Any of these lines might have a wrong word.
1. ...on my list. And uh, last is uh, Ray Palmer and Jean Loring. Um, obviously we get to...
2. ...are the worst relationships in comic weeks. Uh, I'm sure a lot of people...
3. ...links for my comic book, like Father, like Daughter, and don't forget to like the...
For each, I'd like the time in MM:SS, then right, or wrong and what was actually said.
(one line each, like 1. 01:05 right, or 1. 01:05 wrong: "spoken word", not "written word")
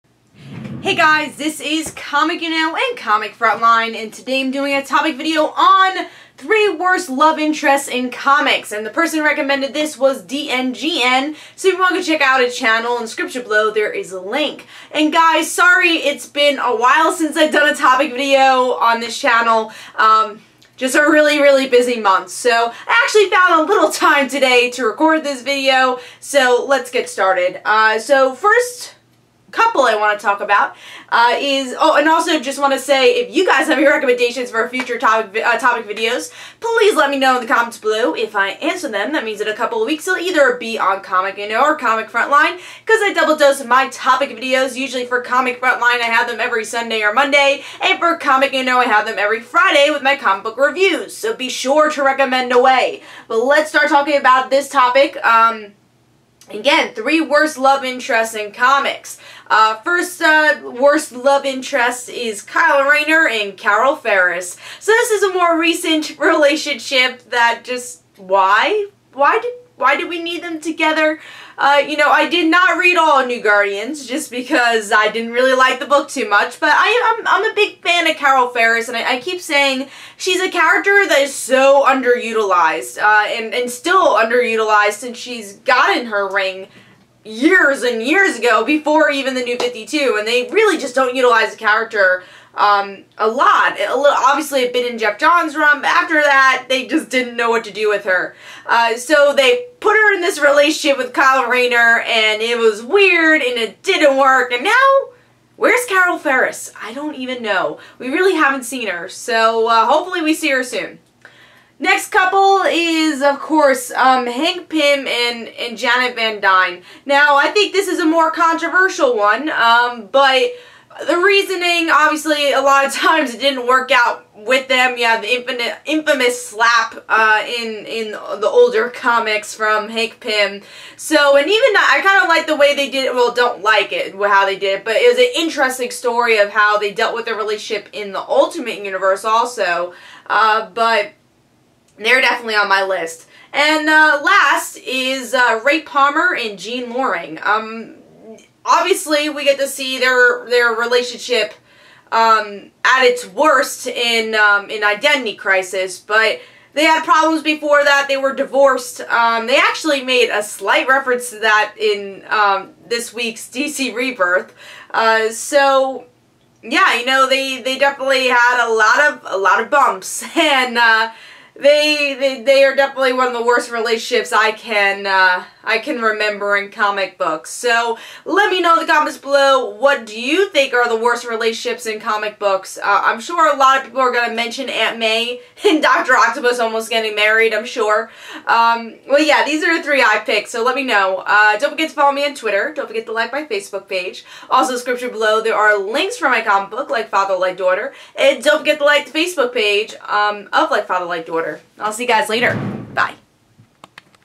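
1. 02:22 right
2. 03:00 wrong: "books", not "weeks"
3. 03:15 right.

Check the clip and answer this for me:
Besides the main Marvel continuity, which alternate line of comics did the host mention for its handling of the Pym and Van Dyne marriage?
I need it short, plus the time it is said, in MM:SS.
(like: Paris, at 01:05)
Ultimate Universe, at 02:18.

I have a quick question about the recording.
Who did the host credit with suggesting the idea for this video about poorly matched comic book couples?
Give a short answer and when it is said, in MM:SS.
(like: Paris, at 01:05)
DNGN, at 00:10.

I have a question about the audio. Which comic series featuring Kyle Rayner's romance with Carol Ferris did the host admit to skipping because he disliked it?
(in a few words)
New Guardians.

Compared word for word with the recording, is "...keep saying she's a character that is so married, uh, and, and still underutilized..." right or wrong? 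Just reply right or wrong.
wrong.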